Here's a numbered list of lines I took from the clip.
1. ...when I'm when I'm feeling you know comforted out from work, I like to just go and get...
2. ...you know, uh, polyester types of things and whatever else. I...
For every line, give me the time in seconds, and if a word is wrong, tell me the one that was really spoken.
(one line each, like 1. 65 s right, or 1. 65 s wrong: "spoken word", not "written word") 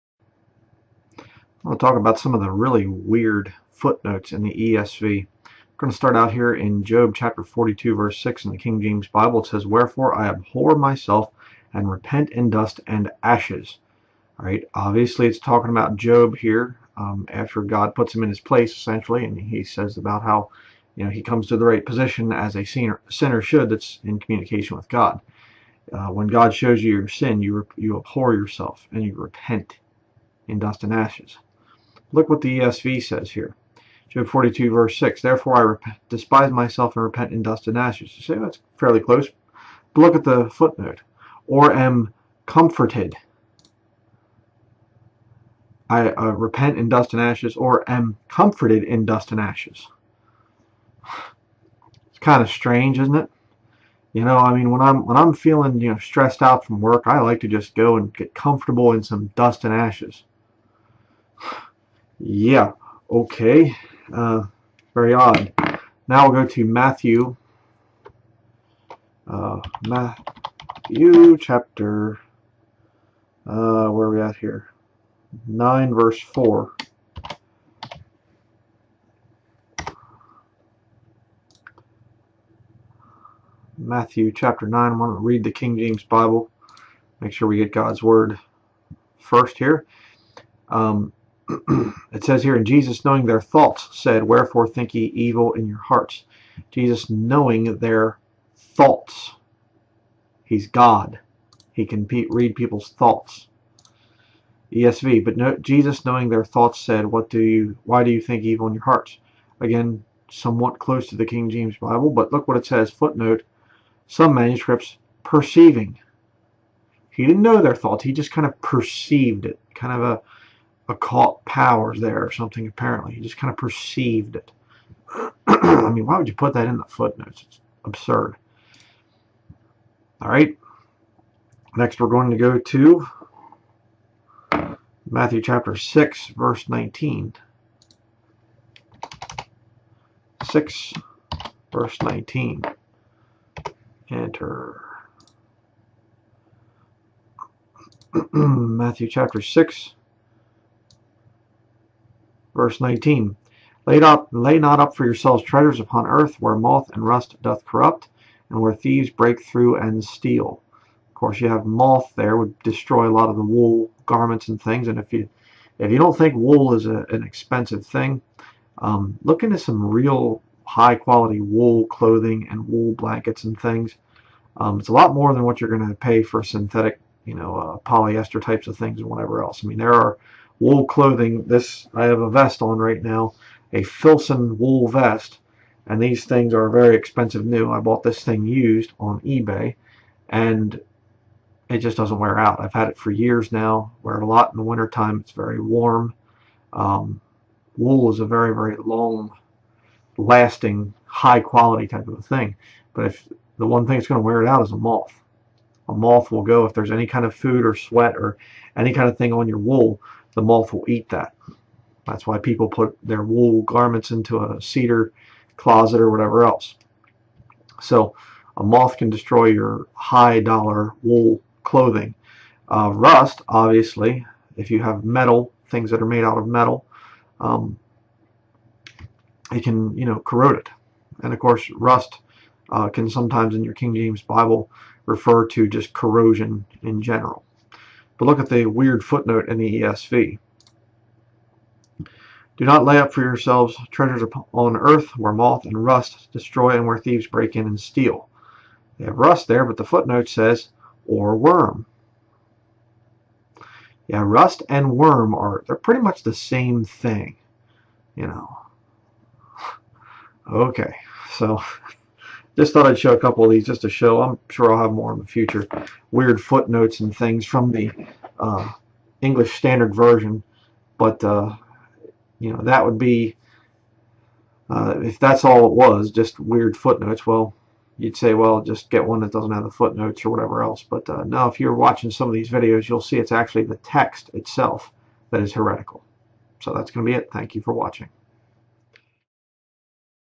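1. 54 s wrong: "stressed", not "comforted"
2. 177 s right.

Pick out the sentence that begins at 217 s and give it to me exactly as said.
So a moth can destroy your high dollar wool clothing.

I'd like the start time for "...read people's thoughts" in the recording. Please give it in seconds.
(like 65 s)
102 s.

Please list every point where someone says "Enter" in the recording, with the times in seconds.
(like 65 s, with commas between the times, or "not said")
144 s.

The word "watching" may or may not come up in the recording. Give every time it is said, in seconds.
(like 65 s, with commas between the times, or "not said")
281 s, 287 s.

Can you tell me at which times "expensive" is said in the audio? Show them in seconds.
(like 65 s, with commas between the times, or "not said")
167 s, 186 s.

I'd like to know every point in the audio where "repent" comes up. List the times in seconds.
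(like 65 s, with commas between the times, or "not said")
11 s, 29 s, 37 s, 46 s.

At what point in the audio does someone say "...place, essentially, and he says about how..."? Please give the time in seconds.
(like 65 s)
18 s.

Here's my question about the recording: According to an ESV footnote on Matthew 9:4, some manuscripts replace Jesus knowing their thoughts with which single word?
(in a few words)
perceiving.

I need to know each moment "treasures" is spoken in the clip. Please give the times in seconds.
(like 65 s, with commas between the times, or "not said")
155 s, 243 s.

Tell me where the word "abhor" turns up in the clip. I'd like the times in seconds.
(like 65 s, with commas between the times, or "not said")
10 s, 27 s.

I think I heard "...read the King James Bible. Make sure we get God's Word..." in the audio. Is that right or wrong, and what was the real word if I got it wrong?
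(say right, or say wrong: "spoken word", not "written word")
right.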